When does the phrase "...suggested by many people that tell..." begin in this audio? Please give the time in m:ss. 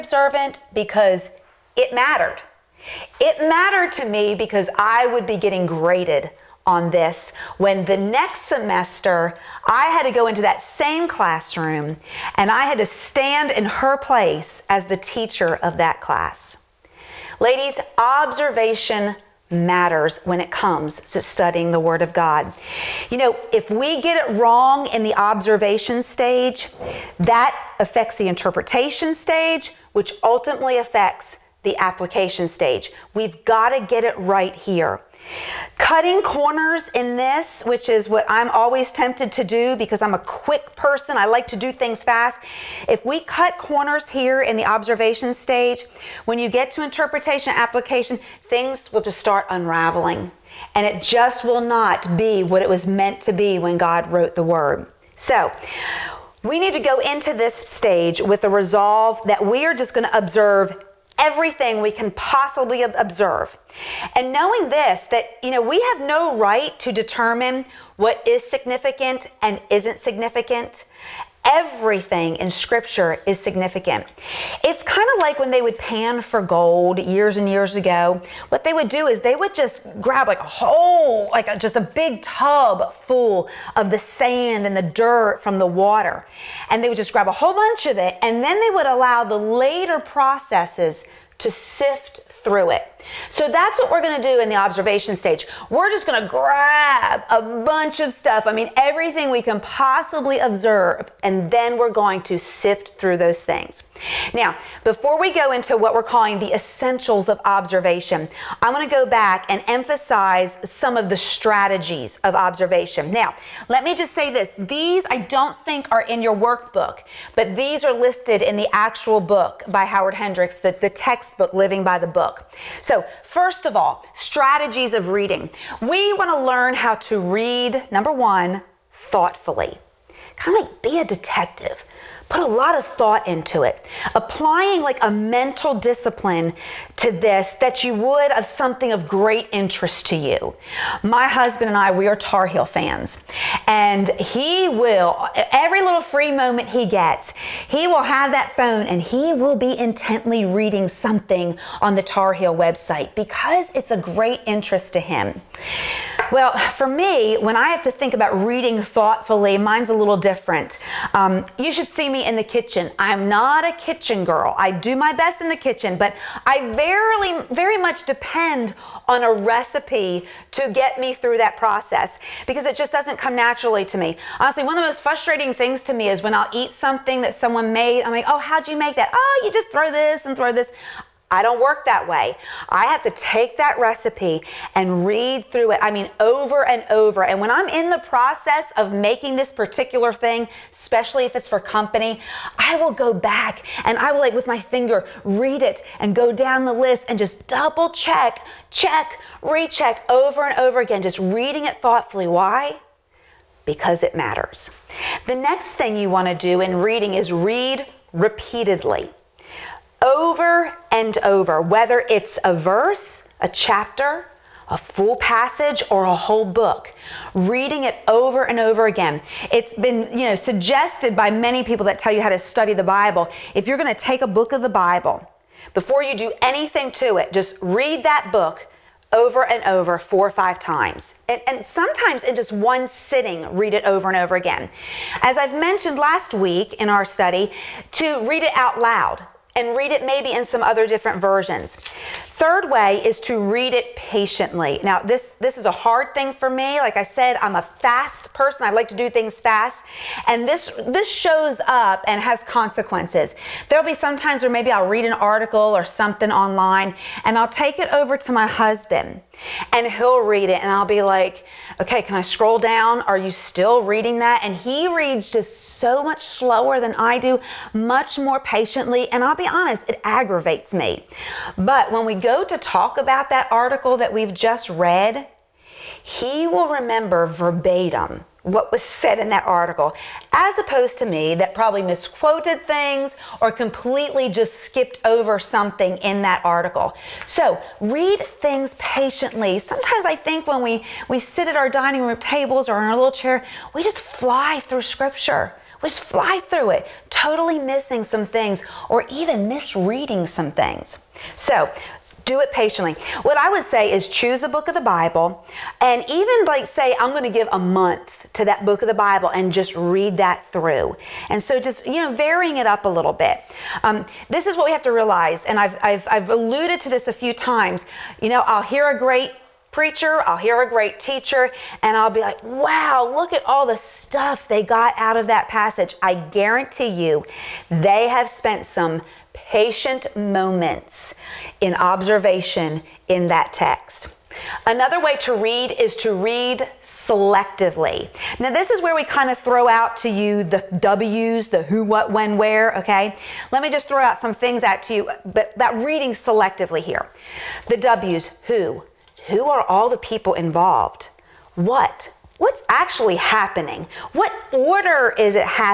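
3:40.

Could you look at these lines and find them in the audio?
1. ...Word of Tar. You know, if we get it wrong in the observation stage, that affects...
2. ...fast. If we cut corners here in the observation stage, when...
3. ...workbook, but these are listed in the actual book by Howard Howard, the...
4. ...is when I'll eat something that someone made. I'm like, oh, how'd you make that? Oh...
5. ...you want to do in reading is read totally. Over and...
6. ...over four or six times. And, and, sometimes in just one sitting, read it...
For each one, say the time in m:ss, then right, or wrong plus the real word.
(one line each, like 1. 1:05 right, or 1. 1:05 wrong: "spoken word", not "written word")
1. 0:21 wrong: "God", not "Tar"
2. 0:42 right
3. 1:56 wrong: "Hendricks", not "Howard"
4. 2:56 right
5. 3:25 wrong: "repeatedly", not "totally"
6. 3:49 wrong: "five", not "six".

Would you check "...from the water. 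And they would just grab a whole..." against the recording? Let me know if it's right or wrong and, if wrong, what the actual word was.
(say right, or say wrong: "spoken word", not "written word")
right.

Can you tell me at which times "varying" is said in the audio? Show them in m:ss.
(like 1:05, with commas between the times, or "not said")
5:12.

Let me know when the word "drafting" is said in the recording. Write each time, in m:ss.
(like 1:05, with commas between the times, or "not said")
not said.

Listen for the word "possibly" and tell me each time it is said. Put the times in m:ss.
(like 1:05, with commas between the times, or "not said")
1:02, 1:39.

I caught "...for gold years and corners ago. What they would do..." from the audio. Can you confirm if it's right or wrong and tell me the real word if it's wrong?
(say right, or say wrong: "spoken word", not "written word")
wrong: "years", not "corners".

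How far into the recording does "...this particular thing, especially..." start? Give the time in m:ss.
3:09.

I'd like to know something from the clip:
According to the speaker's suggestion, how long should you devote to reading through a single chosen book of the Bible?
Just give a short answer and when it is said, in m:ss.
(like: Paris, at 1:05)
a month, at 5:07.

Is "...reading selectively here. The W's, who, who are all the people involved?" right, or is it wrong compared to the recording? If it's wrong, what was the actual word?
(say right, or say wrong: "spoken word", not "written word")
right.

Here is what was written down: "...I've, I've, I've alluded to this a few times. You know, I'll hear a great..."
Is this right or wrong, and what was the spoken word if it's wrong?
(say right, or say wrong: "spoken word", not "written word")
right.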